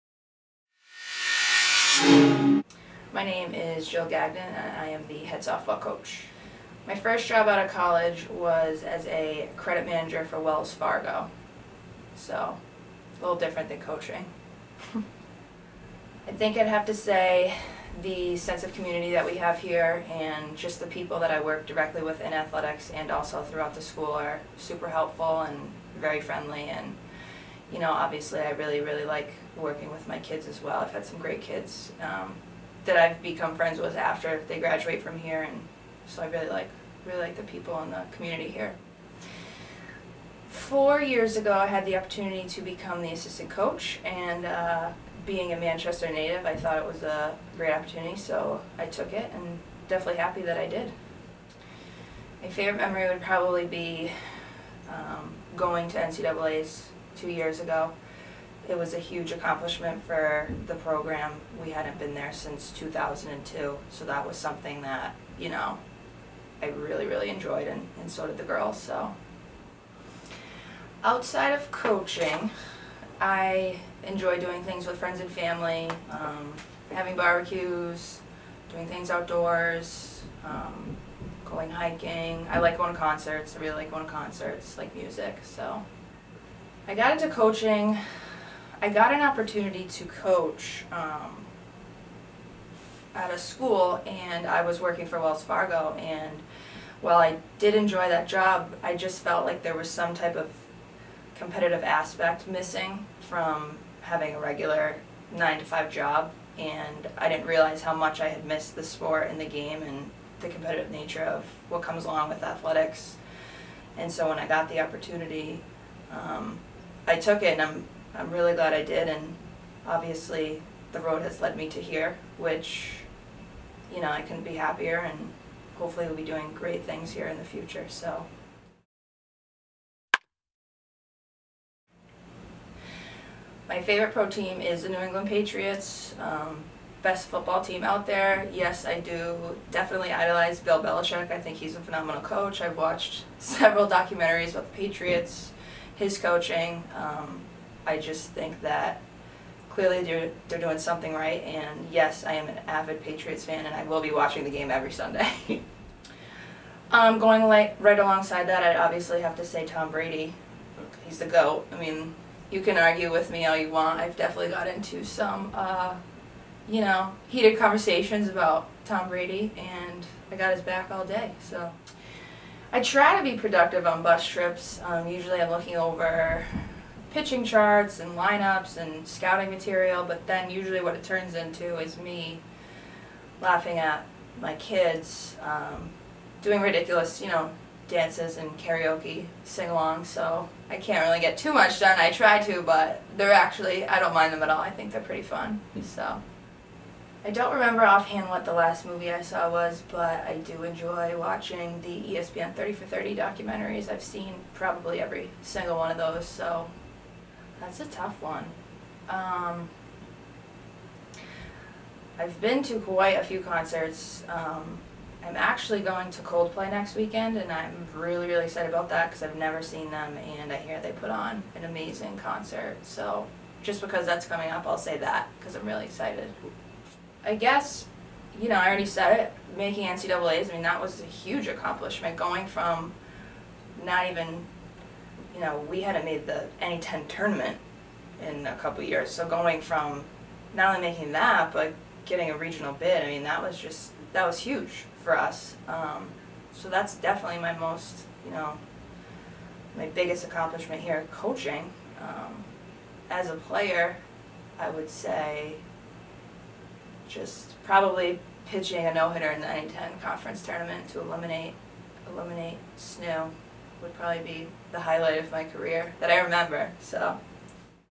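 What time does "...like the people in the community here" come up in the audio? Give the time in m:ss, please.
0:37.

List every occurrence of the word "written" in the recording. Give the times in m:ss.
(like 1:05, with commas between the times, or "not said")
not said.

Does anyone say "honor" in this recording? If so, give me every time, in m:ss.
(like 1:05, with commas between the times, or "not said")
not said.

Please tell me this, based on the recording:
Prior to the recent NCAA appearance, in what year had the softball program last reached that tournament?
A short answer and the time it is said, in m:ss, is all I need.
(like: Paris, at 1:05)
2002, at 1:02.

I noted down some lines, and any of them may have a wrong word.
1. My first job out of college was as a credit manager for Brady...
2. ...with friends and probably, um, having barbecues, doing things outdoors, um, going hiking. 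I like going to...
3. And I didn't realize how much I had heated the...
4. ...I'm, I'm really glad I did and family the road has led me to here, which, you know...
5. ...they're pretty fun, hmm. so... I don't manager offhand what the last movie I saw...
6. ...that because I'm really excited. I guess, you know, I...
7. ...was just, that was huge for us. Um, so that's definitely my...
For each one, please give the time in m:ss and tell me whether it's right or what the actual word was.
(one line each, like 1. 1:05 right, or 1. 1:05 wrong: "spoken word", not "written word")
1. 0:06 wrong: "Wells", not "Brady"
2. 1:14 wrong: "family", not "probably"
3. 1:46 wrong: "missed", not "heated"
4. 1:57 wrong: "obviously", not "family"
5. 3:14 wrong: "remember", not "manager"
6. 3:44 right
7. 4:03 right.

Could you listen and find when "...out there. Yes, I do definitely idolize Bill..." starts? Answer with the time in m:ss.
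2:17.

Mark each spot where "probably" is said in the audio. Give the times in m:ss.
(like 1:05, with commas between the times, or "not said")
0:53, 3:24, 4:17, 4:23.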